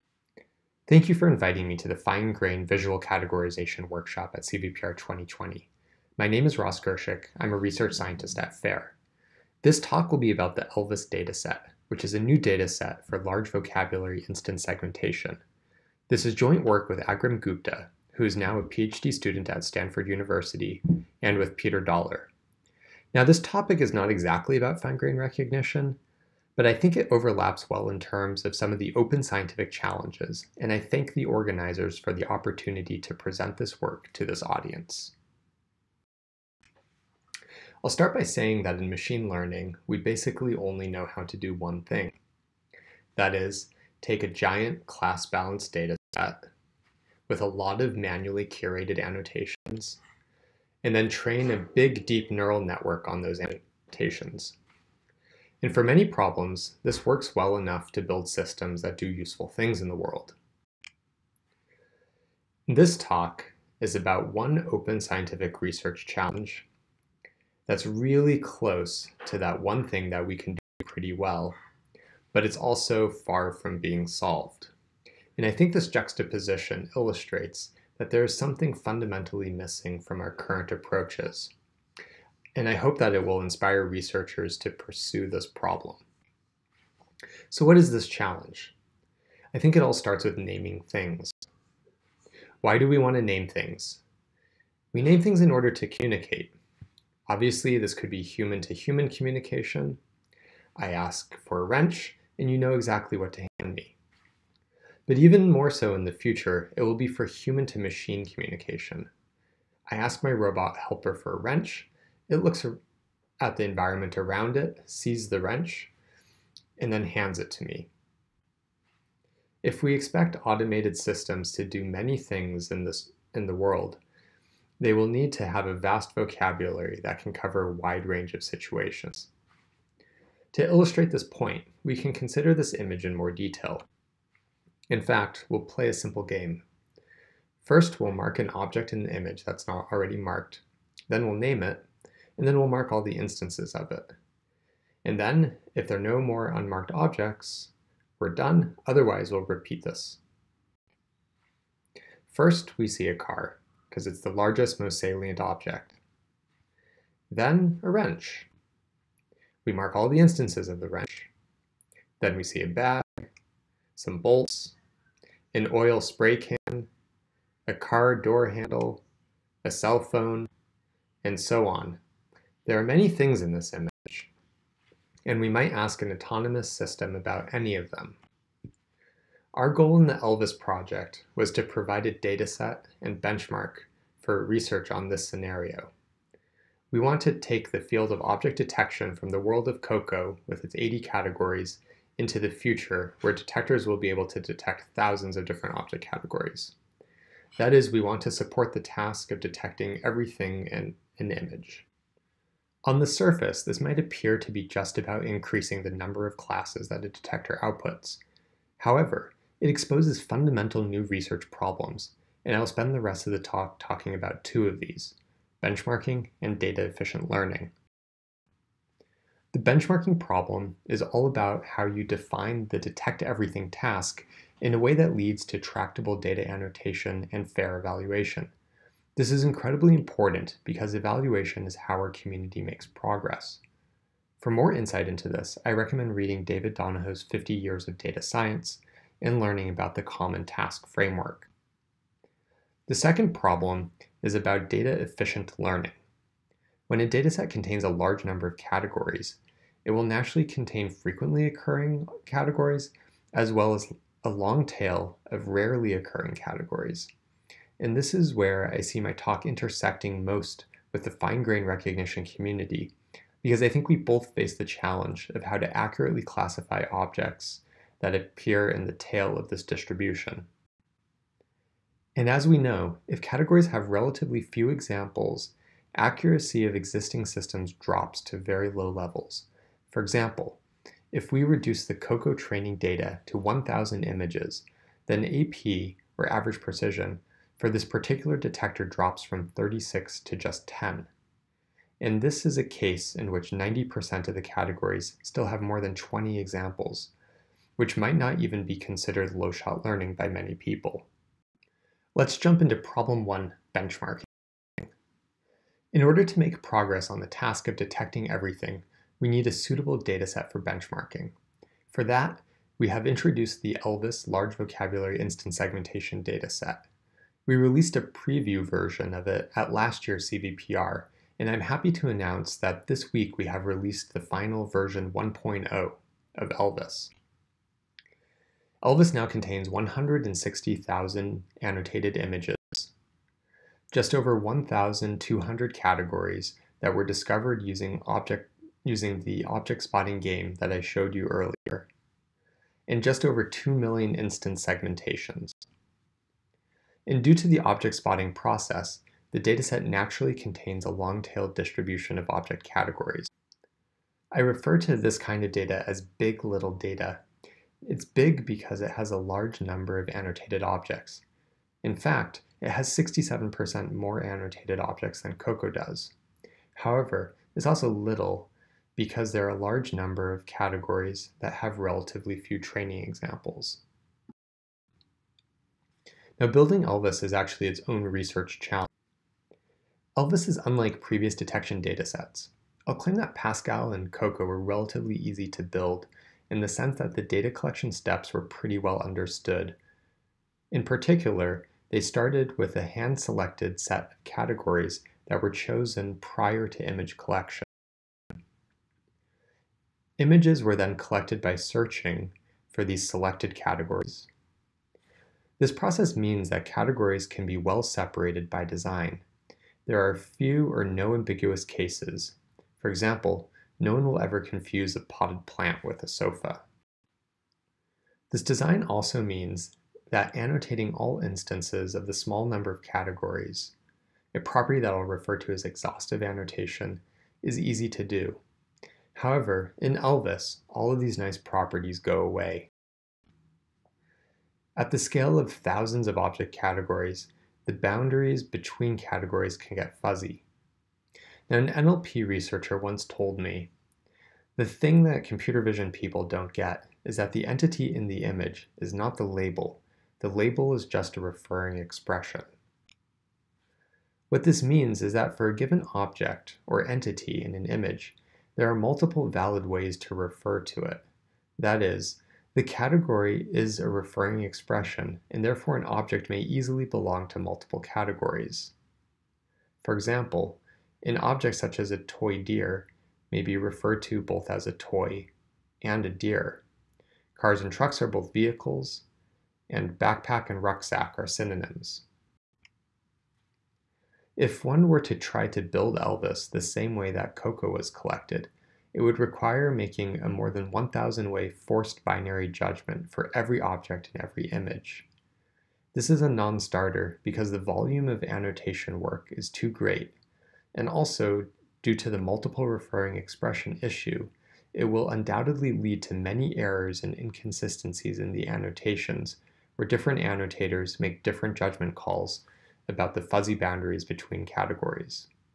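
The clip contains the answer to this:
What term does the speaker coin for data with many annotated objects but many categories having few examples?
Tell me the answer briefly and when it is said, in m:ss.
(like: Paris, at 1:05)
big little data, at 5:56.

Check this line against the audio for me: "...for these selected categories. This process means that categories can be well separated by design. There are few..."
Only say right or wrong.
right.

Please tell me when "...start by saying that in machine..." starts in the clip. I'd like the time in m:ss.
0:37.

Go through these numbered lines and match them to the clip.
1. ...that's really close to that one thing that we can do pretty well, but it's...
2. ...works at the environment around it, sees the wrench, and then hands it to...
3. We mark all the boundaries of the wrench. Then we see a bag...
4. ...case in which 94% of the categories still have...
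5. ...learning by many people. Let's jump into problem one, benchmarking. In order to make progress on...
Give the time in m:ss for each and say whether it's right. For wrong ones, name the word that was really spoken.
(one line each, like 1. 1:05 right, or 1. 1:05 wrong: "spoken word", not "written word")
1. 1:07 right
2. 1:52 wrong: "looks", not "works"
3. 2:39 wrong: "instances", not "boundaries"
4. 4:52 wrong: "90", not "94"
5. 4:59 right.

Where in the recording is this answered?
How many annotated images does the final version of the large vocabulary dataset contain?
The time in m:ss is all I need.
5:29.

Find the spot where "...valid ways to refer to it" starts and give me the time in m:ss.
7:39.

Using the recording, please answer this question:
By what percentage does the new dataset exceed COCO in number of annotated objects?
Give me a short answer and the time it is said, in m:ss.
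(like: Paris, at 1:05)
67%, at 6:02.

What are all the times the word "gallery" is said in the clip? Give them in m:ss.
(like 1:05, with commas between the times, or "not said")
not said.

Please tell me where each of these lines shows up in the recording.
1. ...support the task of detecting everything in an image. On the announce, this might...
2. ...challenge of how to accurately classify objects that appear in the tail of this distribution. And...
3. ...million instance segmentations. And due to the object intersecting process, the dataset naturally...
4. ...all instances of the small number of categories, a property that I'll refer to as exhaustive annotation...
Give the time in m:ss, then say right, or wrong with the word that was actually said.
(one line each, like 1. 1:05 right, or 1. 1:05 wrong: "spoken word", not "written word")
1. 3:18 wrong: "surface", not "announce"
2. 4:24 right
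3. 5:43 wrong: "spotting", not "intersecting"
4. 7:00 right.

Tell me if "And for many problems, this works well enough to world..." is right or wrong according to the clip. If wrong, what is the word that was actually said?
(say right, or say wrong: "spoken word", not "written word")
wrong: "build", not "world".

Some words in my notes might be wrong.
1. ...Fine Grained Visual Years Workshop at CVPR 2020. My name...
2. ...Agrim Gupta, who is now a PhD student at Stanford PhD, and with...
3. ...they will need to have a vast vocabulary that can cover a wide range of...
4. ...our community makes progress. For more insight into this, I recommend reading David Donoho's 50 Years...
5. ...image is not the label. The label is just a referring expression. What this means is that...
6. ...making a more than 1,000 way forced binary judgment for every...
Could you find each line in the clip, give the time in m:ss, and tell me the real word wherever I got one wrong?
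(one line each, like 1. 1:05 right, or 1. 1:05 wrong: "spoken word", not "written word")
1. 0:01 wrong: "Categorization", not "Years"
2. 0:16 wrong: "University", not "PhD"
3. 2:04 right
4. 3:51 right
5. 7:28 right
6. 8:09 right.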